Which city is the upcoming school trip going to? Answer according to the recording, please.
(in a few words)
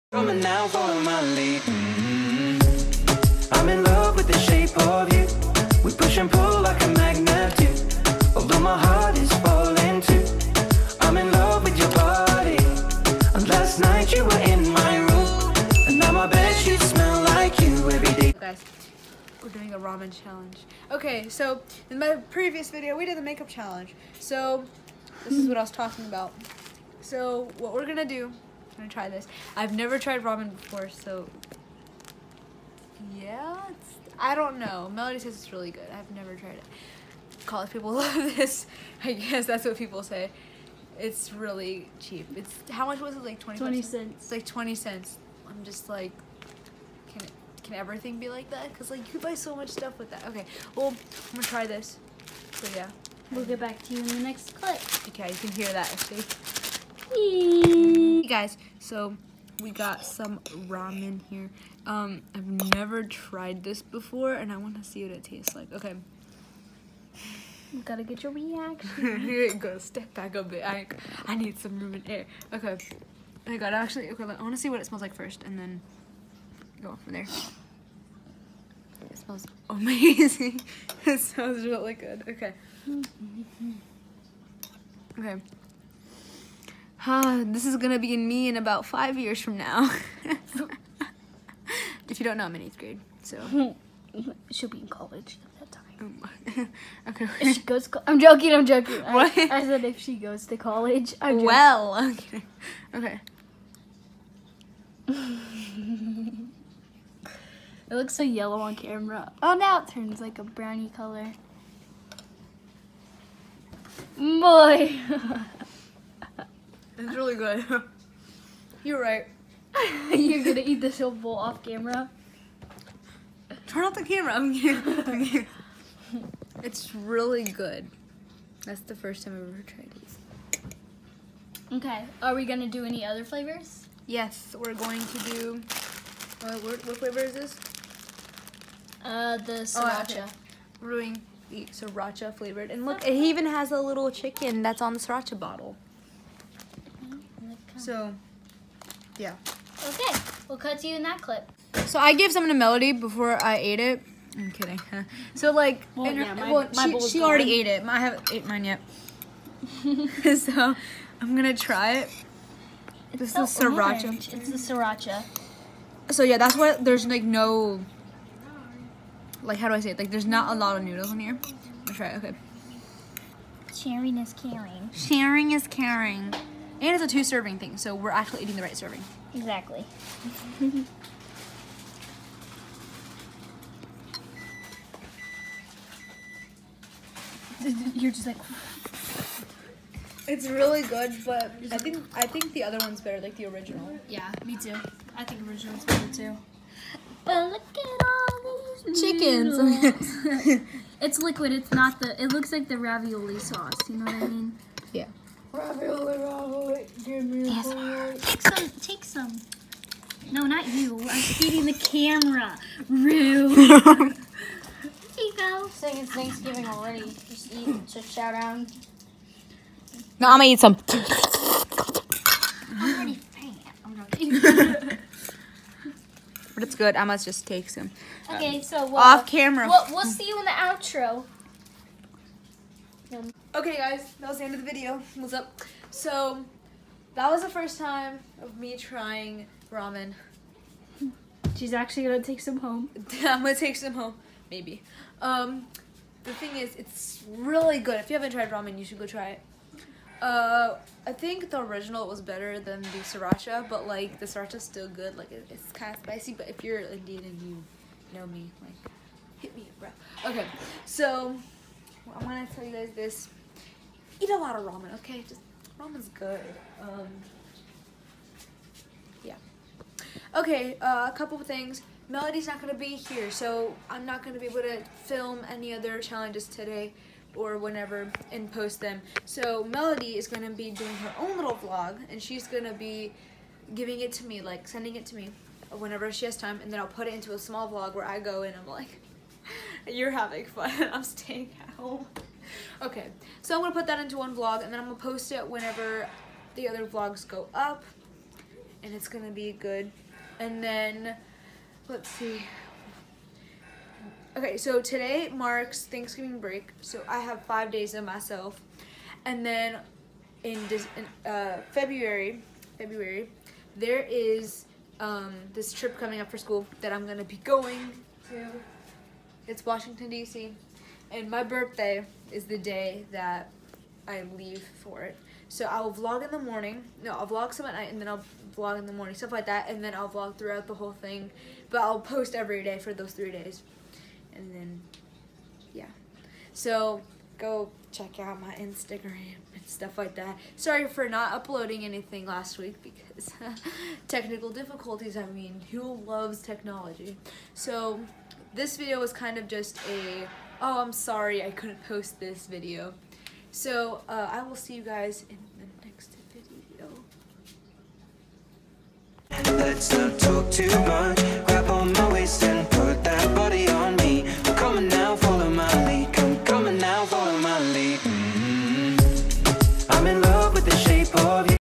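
Washington, D.C.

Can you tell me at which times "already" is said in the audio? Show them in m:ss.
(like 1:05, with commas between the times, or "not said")
2:37, 3:36, 3:42.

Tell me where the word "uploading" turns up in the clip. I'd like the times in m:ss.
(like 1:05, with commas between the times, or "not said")
5:41.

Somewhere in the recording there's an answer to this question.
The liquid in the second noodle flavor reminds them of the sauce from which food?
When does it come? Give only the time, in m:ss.
3:22.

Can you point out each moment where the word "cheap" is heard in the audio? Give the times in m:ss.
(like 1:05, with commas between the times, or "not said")
0:41.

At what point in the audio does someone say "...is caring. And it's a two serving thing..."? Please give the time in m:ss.
2:55.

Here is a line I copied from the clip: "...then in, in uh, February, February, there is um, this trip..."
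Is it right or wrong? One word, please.
right.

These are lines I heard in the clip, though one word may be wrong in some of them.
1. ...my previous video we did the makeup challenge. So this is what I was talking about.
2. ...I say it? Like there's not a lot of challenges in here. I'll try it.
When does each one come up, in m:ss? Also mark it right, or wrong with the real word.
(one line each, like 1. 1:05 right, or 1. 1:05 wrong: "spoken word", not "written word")
1. 0:22 right
2. 2:49 wrong: "noodles", not "challenges".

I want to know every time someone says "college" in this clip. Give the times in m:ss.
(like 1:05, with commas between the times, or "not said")
0:37, 1:34, 1:40.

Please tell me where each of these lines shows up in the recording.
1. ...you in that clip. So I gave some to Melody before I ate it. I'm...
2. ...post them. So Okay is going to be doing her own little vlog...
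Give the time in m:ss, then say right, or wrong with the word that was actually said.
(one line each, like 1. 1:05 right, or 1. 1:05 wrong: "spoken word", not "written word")
1. 2:30 right
2. 4:38 wrong: "Melody", not "Okay".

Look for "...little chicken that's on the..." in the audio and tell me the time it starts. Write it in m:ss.
2:23.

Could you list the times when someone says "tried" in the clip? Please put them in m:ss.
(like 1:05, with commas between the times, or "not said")
0:29, 0:36, 1:03, 2:09, 4:08.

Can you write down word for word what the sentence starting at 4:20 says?
Okay, so I want to tell you guys this.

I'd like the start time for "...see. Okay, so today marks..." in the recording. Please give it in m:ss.
5:02.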